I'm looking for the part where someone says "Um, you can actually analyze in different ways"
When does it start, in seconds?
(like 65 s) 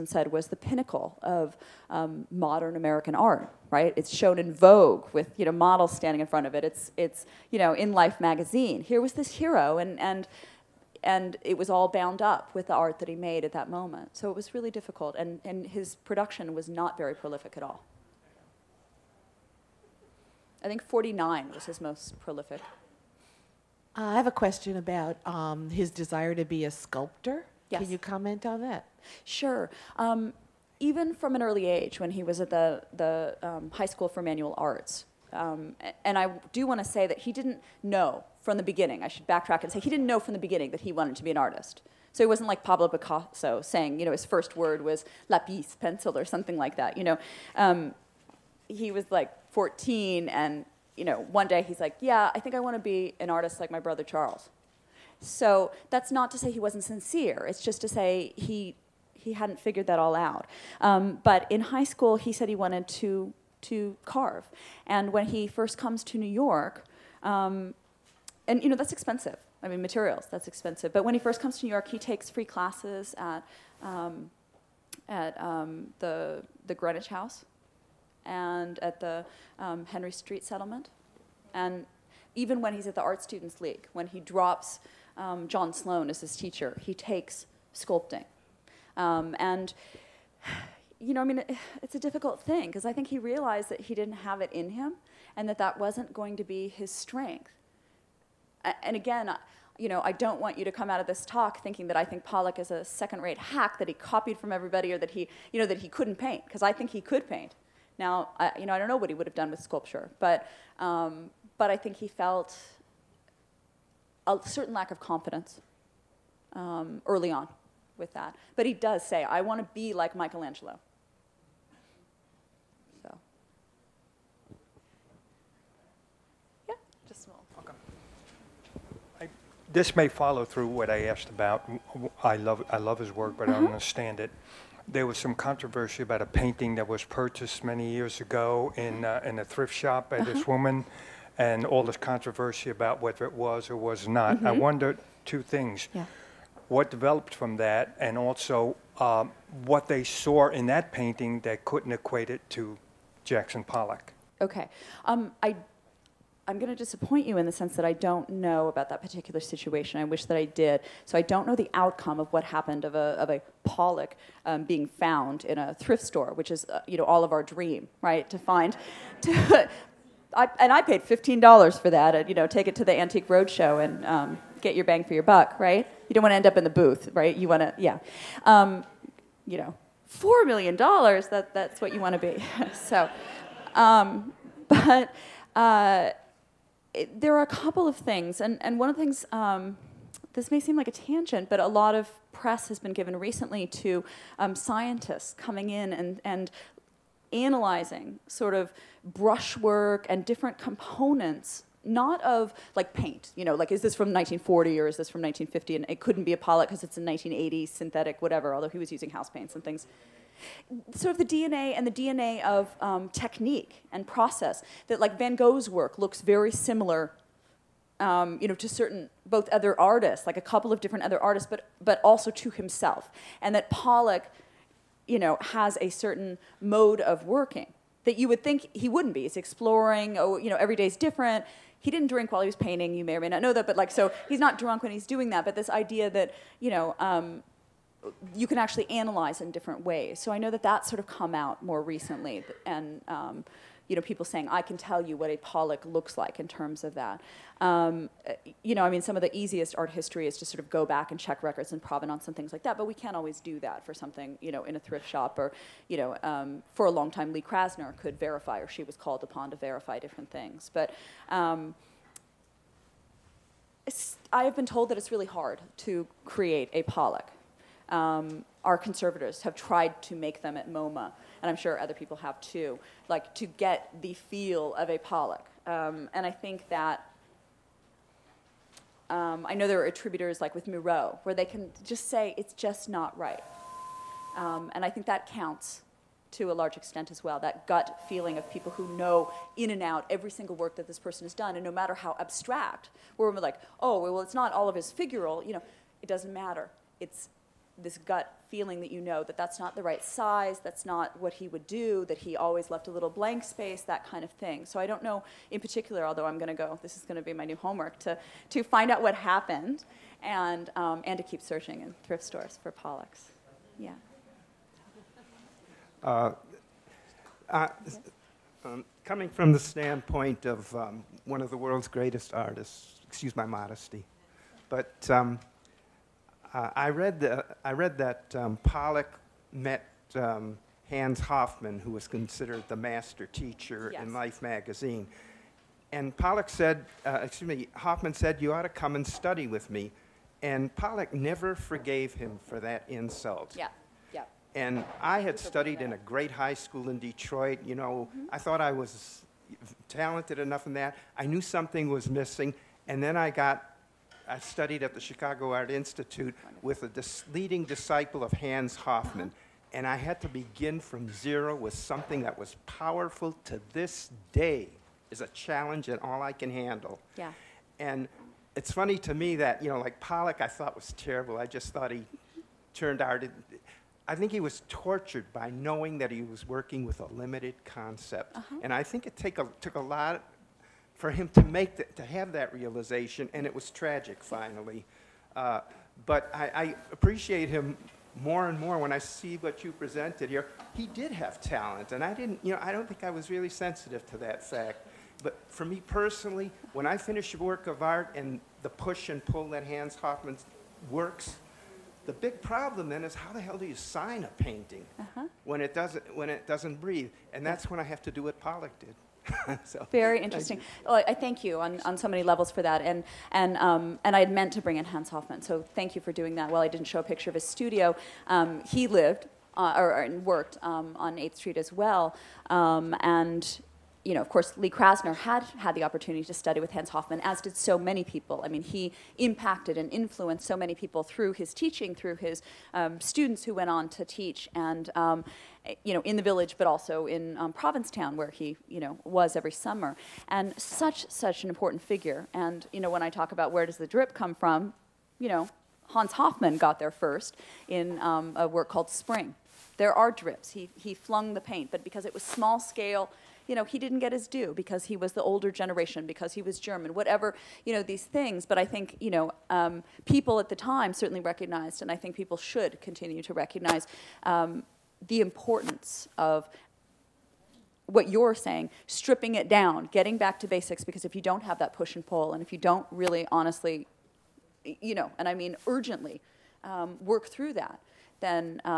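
237 s.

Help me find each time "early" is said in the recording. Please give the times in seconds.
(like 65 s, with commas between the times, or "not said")
31 s, 117 s.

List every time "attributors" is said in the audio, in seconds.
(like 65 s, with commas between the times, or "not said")
279 s.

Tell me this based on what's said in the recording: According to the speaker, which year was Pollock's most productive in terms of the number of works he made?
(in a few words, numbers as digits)
1949.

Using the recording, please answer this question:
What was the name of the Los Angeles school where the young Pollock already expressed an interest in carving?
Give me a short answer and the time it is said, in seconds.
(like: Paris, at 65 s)
High School for Manual Arts, at 33 s.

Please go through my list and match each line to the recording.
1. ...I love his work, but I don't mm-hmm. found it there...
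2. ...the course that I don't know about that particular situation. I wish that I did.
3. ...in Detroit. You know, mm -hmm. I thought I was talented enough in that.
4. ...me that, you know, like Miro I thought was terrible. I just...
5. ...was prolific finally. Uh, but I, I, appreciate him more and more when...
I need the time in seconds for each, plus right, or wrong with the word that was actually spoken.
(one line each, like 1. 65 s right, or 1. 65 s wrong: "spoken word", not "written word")
1. 132 s wrong: "understand", not "found"
2. 157 s wrong: "sense", not "course"
3. 346 s right
4. 369 s wrong: "Pollock", not "Miro"
5. 383 s wrong: "tragic", not "prolific".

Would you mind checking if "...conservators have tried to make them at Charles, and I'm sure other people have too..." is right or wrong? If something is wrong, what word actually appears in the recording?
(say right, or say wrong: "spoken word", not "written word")
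wrong: "MoMA", not "Charles".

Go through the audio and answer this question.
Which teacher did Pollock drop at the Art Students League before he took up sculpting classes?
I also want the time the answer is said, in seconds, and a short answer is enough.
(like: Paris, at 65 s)
John Sloan, at 85 s.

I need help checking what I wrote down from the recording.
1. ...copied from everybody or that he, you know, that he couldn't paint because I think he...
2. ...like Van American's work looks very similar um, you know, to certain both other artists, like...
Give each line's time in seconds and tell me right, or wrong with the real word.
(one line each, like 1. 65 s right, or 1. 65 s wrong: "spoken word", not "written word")
1. 103 s right
2. 215 s wrong: "Gogh", not "American".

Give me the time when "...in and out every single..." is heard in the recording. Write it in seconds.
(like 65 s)
289 s.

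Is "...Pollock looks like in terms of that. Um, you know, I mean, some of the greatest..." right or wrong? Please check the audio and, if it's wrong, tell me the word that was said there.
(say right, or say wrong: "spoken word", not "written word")
wrong: "easiest", not "greatest".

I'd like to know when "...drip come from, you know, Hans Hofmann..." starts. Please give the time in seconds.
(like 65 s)
443 s.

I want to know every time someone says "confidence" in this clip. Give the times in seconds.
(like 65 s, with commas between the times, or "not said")
114 s.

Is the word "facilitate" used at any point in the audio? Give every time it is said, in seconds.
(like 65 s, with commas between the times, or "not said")
not said.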